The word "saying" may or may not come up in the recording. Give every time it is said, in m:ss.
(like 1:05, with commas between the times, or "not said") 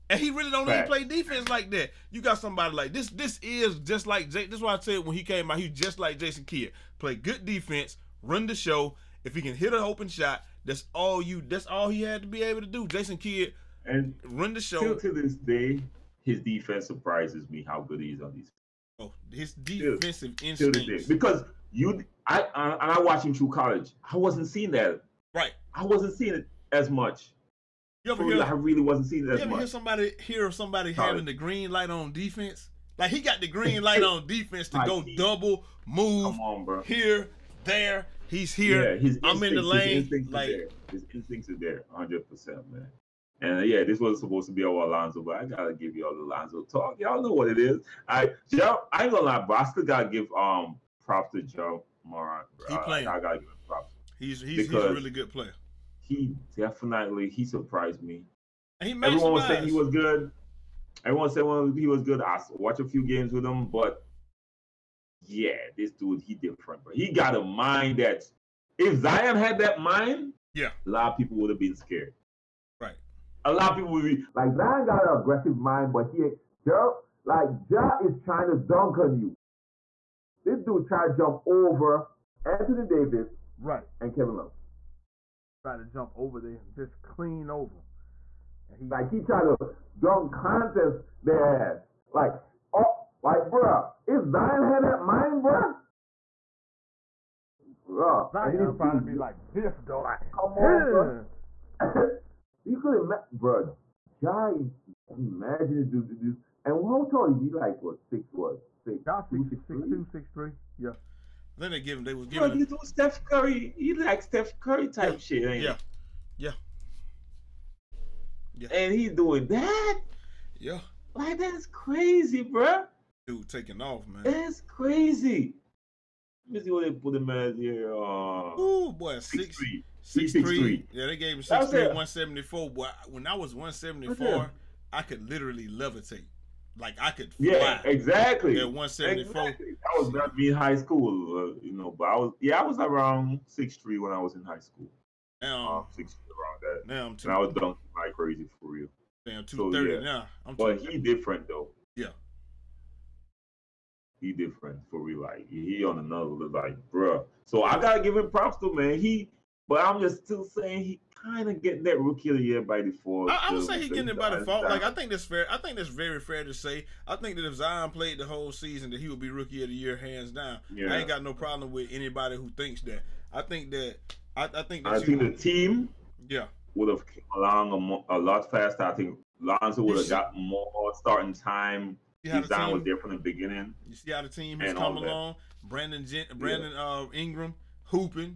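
0:59, 2:40.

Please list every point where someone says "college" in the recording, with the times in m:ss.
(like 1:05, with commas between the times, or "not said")
0:23.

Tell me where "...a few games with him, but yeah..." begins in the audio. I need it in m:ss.
1:02.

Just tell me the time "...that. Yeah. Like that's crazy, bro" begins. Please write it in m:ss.
1:59.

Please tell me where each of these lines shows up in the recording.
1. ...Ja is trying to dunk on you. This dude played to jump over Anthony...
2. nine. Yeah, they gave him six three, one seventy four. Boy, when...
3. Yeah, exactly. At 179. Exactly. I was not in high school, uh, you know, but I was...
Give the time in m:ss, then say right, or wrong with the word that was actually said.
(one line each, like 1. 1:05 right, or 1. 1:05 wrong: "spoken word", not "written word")
1. 1:17 wrong: "tried", not "played"
2. 2:10 wrong: "three", not "nine"
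3. 2:17 wrong: "174", not "179".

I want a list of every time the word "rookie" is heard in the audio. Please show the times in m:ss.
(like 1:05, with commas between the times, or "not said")
2:41, 2:49.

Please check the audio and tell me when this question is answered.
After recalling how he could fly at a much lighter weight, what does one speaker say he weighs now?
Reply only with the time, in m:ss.
2:29.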